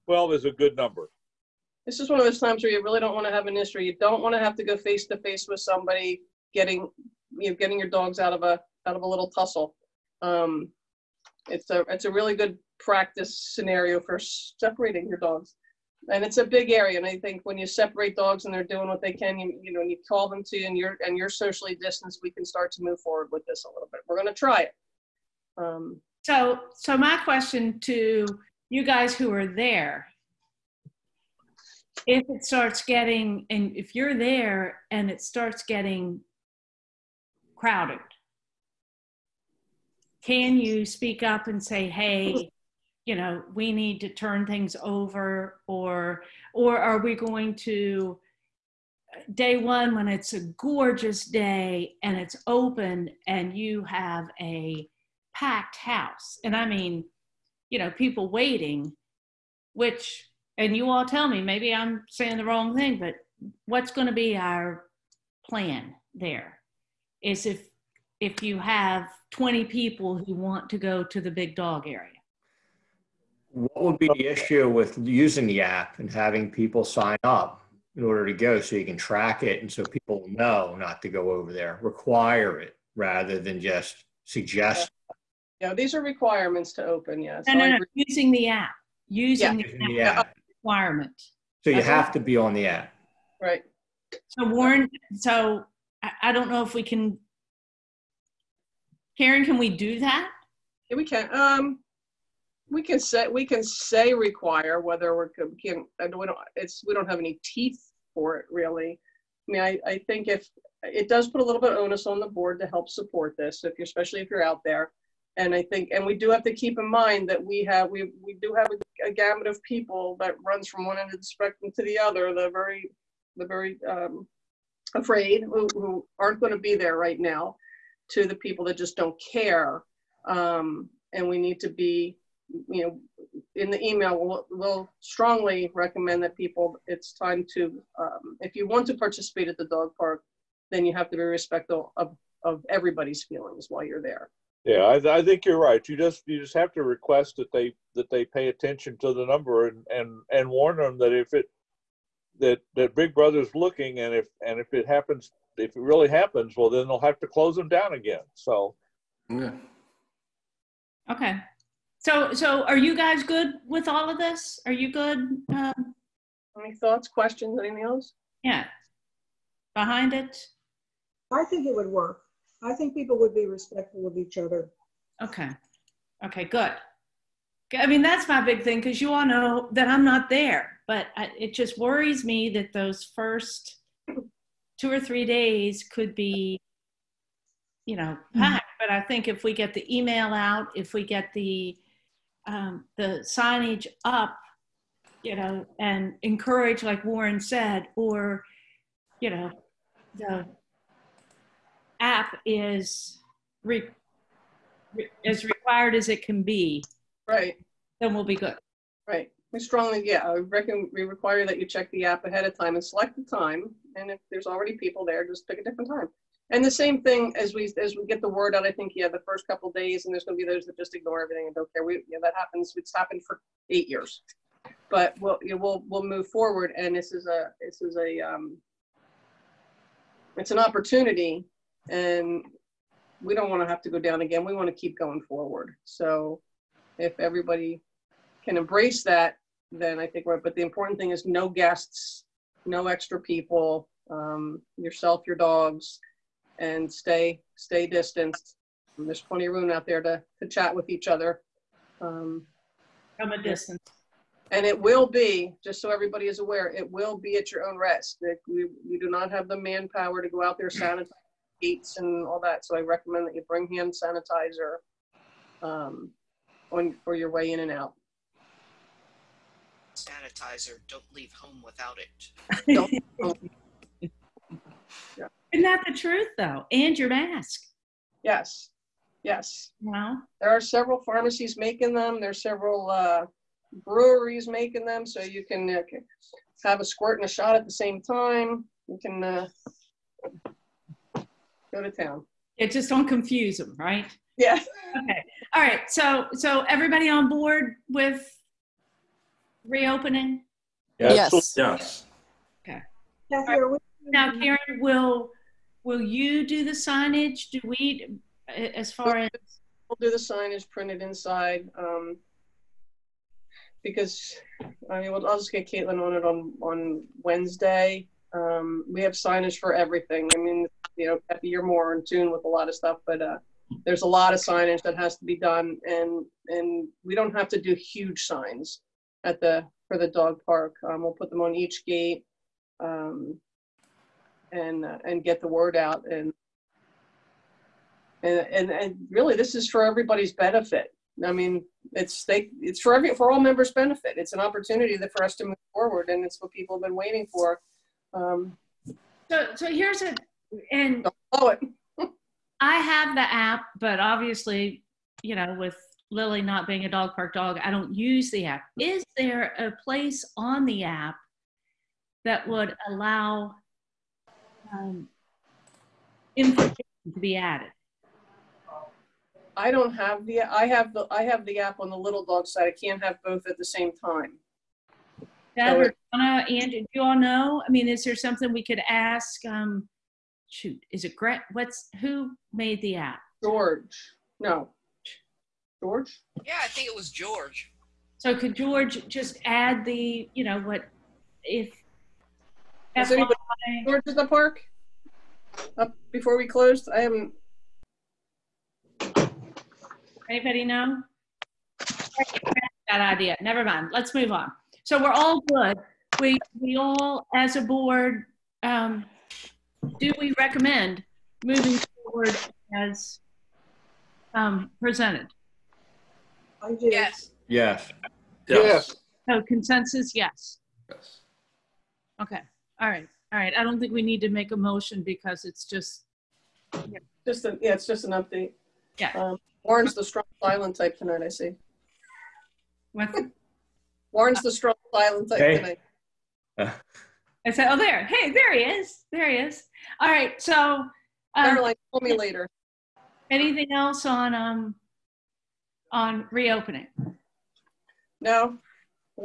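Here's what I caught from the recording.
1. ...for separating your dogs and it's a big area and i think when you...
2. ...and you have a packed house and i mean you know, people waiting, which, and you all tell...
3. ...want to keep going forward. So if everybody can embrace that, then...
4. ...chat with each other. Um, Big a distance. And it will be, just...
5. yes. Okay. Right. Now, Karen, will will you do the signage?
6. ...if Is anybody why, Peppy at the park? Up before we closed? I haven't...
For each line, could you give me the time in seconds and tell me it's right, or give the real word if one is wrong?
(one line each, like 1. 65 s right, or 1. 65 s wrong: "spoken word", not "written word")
1. 14 s right
2. 53 s right
3. 234 s right
4. 250 s wrong: "From", not "Big"
5. 301 s right
6. 391 s wrong: "George", not "Peppy".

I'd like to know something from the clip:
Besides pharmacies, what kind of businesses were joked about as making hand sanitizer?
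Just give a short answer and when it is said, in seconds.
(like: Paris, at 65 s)
Breweries, at 283 s.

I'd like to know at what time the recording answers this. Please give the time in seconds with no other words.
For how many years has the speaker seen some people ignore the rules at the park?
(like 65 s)
223 s.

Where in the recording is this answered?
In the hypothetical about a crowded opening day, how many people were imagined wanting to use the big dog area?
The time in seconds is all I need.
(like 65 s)
69 s.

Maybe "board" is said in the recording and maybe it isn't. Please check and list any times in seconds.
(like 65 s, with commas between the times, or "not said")
112 s, 297 s, 407 s.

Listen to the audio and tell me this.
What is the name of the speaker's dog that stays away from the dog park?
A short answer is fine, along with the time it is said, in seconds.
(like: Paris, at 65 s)
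Lily, at 356 s.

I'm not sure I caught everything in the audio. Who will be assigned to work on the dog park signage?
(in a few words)
Caitlin.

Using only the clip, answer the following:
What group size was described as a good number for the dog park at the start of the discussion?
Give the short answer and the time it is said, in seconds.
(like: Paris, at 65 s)
12, at 0 s.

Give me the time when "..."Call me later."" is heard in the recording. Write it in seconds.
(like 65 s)
441 s.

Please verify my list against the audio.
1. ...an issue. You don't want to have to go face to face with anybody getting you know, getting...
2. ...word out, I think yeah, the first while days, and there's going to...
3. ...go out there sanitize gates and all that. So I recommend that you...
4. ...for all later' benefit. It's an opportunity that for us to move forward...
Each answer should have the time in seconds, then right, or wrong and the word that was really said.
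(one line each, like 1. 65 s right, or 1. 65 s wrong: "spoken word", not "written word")
1. 3 s wrong: "somebody", not "anybody"
2. 218 s wrong: "couple", not "while"
3. 260 s right
4. 343 s wrong: "members", not "later".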